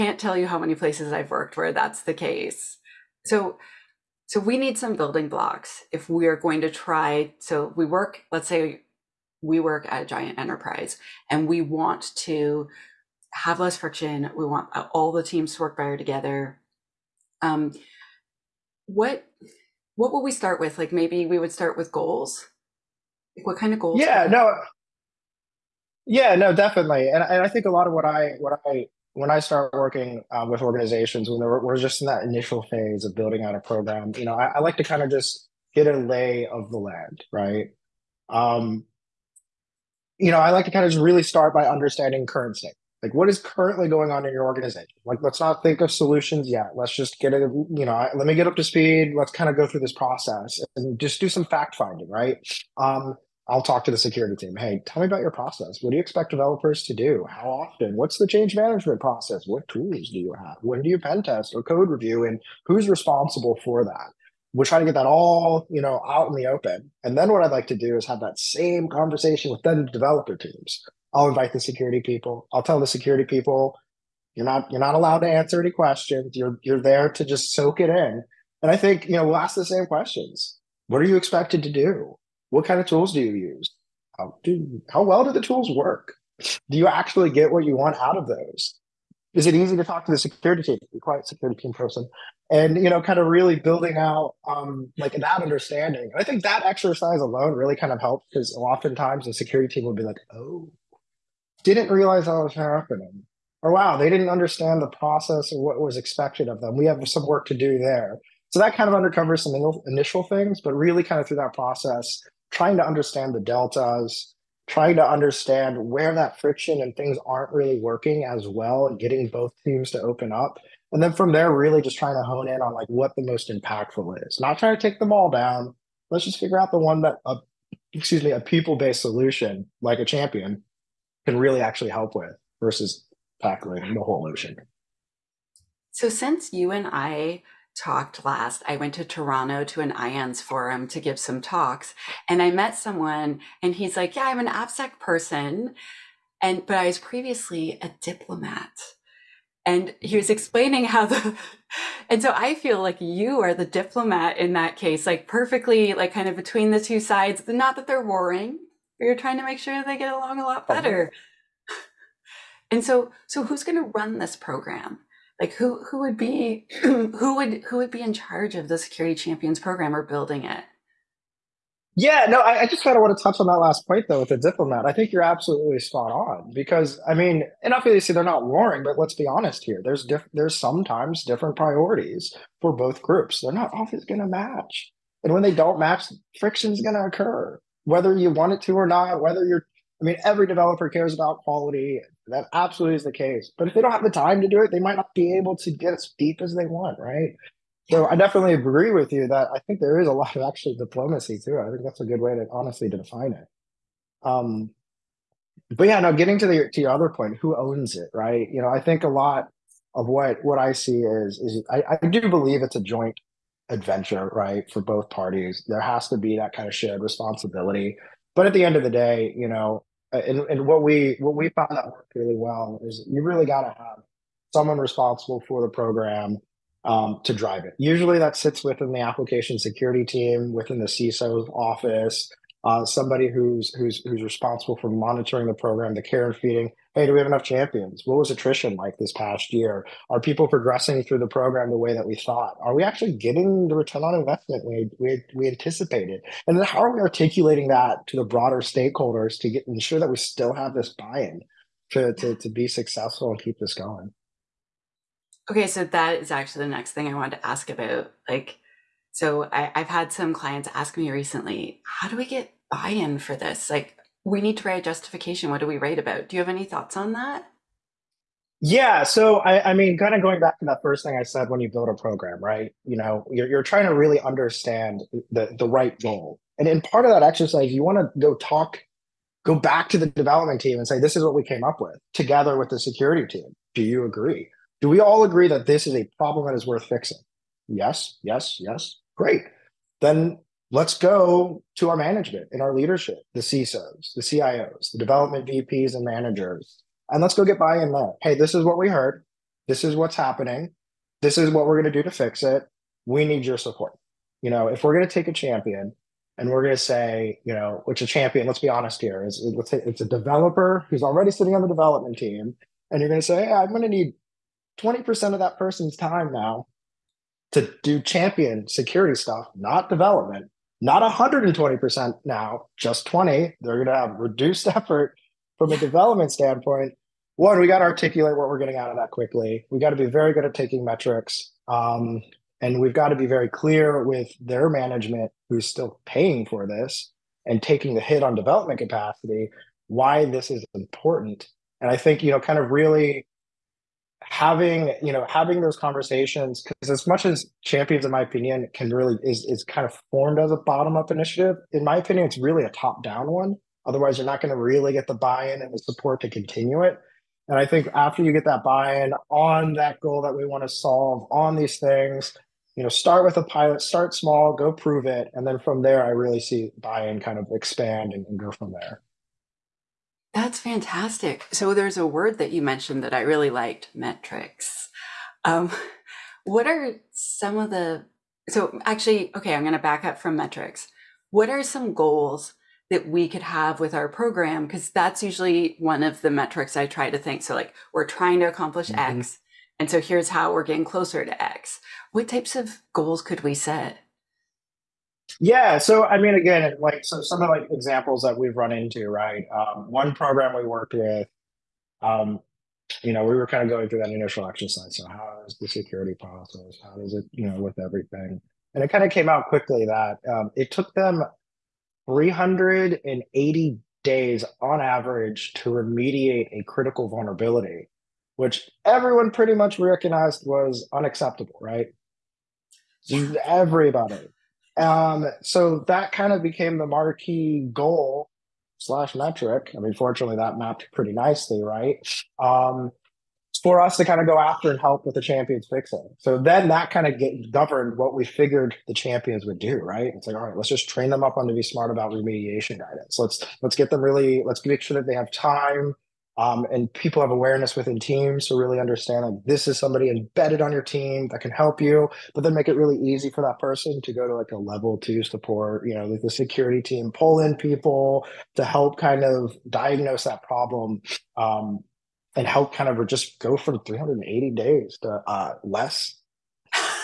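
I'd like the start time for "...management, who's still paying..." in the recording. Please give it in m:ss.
5:34.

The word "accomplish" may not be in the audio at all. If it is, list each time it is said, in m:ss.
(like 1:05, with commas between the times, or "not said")
6:28.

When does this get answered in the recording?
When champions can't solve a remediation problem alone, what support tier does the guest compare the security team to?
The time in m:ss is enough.
7:34.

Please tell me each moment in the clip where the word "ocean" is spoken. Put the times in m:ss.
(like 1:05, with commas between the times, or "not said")
2:14.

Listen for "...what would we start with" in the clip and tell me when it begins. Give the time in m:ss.
0:19.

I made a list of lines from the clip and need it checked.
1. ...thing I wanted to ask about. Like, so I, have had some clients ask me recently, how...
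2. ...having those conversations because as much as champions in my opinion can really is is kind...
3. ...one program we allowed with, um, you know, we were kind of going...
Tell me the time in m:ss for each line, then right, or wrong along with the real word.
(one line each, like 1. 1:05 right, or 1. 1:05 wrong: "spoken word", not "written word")
1. 4:16 right
2. 5:45 right
3. 6:39 wrong: "worked", not "allowed".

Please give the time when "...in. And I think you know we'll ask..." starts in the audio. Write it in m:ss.
1:17.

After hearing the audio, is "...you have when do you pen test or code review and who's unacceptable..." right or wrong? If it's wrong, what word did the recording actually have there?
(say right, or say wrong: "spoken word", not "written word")
wrong: "responsible", not "unacceptable".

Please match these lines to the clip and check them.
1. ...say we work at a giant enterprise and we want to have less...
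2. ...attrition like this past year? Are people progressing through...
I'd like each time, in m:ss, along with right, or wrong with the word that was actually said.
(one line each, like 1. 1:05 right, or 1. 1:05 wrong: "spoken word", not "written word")
1. 0:08 right
2. 3:58 right.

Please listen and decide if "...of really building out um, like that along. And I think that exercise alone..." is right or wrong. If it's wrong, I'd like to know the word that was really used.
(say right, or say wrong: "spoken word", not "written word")
wrong: "understanding", not "along".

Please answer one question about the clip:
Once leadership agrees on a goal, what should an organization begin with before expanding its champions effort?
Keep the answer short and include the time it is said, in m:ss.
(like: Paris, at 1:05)
a pilot, at 6:03.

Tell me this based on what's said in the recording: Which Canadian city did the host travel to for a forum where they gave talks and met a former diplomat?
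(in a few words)
Toronto.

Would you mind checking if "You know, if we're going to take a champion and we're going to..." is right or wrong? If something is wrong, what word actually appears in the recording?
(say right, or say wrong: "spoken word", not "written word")
right.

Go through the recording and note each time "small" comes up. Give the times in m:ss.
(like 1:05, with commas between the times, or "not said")
6:04.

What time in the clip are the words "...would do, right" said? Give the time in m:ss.
7:19.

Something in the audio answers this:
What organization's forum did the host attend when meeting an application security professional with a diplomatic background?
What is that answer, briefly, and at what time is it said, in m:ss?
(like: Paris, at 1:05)
IANS, at 2:19.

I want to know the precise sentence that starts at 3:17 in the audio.
So I definitely agree with you that I think there is a lot of actually diplomacy too.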